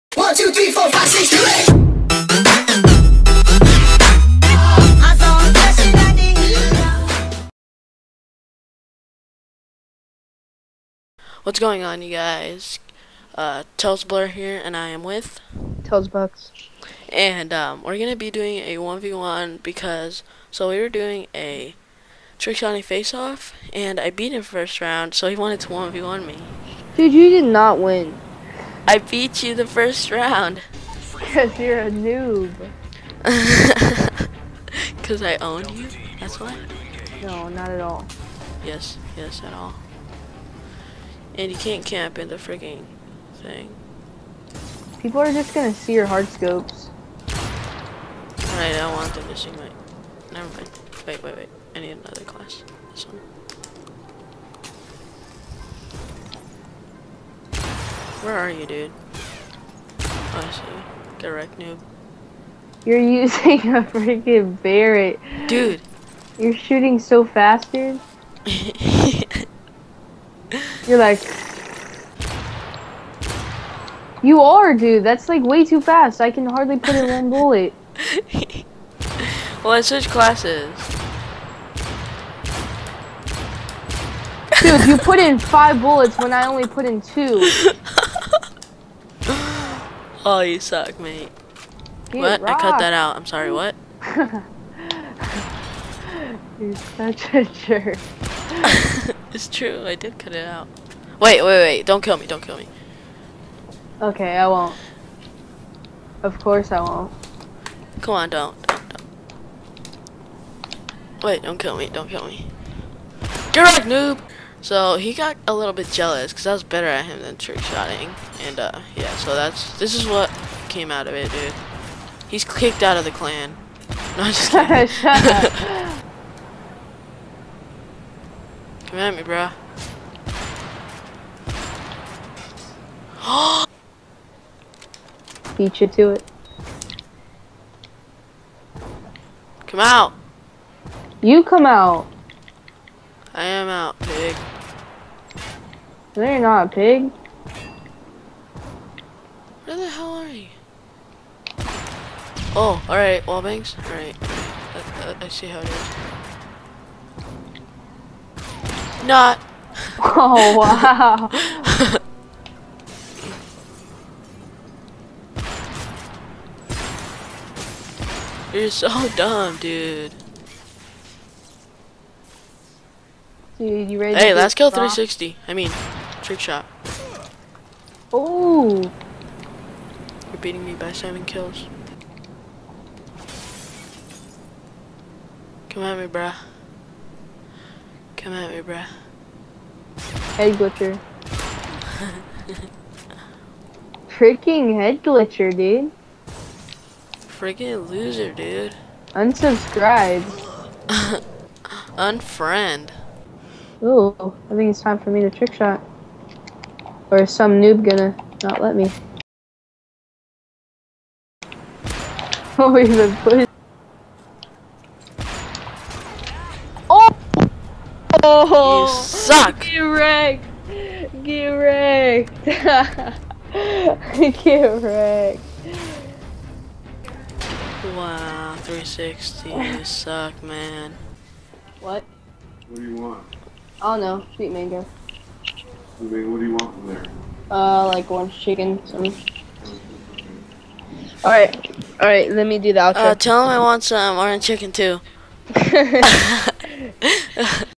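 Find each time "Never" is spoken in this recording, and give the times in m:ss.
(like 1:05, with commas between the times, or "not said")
0:50.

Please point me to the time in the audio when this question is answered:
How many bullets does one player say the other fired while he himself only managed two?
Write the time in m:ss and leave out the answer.
1:25.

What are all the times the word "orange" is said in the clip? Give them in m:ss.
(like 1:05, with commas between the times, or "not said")
3:58, 4:04.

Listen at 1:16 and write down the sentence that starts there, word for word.
I can hardly put in one bullet.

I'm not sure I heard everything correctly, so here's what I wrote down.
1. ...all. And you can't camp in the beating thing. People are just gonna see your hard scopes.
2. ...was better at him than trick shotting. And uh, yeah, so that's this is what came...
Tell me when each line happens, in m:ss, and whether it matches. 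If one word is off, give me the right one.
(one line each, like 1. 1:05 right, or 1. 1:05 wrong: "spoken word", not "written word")
1. 0:39 wrong: "freaking", not "beating"
2. 1:56 right.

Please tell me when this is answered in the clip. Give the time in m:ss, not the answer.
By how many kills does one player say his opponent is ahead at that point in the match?
3:00.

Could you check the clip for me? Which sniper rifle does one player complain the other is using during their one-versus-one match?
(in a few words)
Barrett.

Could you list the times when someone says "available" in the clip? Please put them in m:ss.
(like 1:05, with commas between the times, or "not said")
not said.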